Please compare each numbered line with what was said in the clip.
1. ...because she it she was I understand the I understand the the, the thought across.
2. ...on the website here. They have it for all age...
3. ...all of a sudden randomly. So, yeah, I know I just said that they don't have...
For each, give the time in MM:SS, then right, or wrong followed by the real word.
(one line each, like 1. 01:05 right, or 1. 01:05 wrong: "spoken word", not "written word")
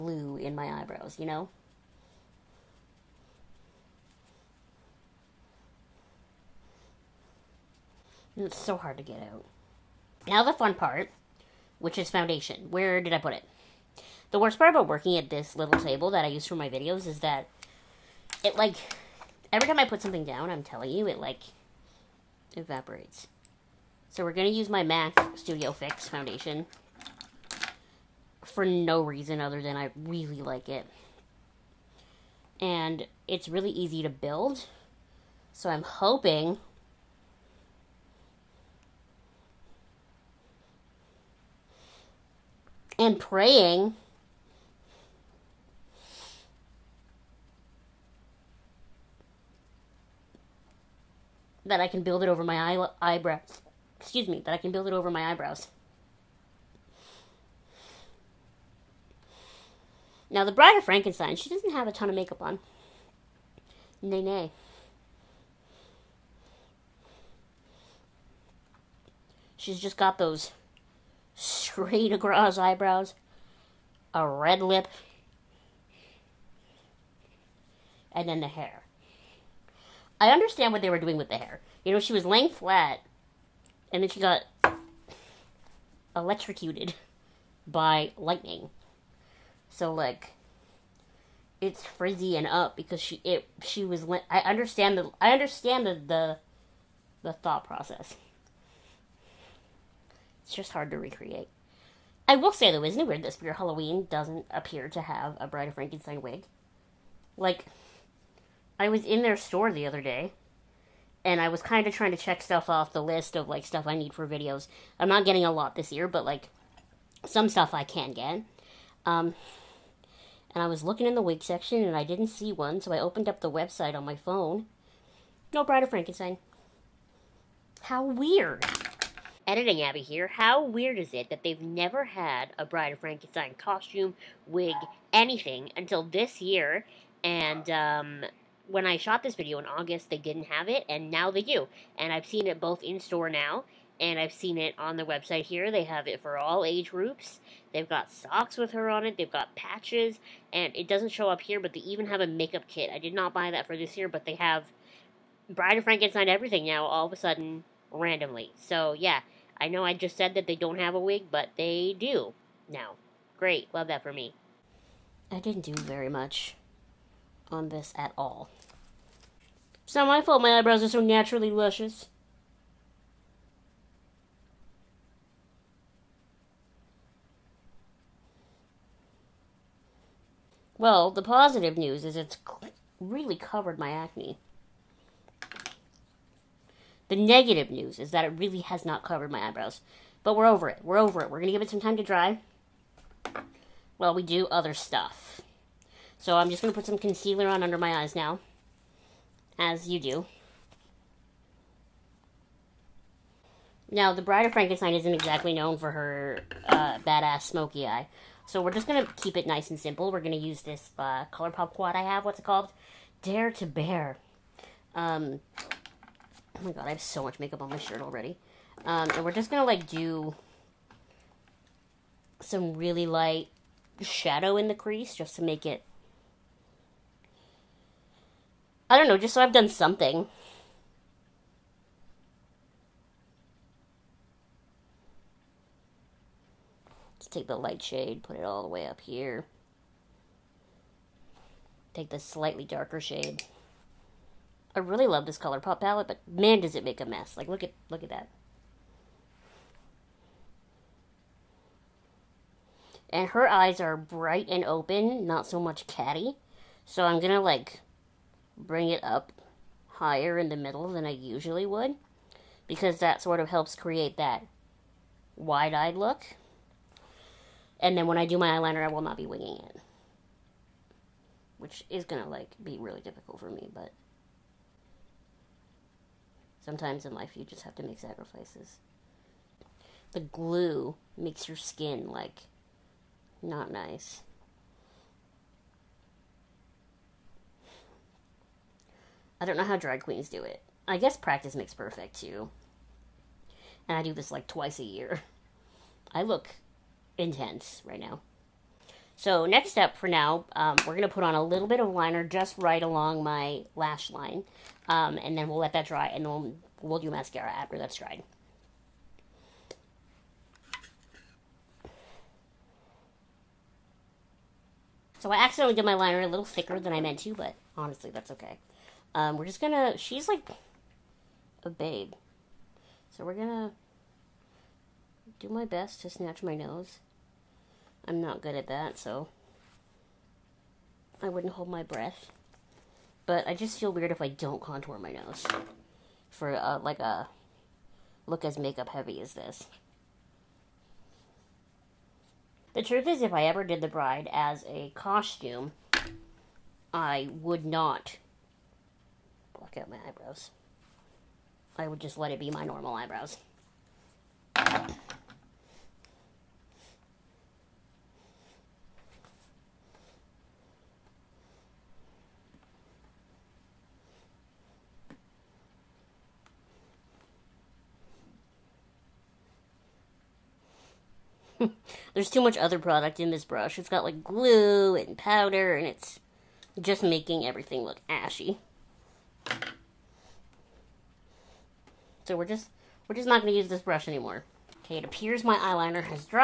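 1. 01:32 wrong: "process", not "across"
2. 02:24 right
3. 02:36 right.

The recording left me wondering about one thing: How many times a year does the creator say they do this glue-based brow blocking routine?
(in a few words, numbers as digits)
2.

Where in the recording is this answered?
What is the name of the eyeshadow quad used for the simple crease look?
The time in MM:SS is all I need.
03:33.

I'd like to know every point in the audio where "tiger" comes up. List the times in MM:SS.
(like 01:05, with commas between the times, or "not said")
not said.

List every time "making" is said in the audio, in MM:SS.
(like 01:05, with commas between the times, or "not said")
06:17.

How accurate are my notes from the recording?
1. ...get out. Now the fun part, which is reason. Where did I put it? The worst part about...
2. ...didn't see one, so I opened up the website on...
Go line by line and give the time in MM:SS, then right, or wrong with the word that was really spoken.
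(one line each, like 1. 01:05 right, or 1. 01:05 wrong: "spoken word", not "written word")
1. 00:09 wrong: "foundation", not "reason"
2. 02:02 right.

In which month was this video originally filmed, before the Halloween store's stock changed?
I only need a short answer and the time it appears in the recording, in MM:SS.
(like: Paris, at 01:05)
August, at 02:19.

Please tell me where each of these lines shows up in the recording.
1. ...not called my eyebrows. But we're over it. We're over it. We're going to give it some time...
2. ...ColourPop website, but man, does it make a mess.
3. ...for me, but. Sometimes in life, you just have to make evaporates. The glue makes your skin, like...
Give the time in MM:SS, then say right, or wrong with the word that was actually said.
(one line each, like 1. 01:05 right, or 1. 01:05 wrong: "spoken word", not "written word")
1. 03:08 wrong: "covered", not "called"
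2. 04:05 wrong: "palette", not "website"
3. 04:33 wrong: "sacrifices", not "evaporates".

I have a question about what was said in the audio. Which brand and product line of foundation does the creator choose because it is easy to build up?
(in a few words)
MAC Studio Fix.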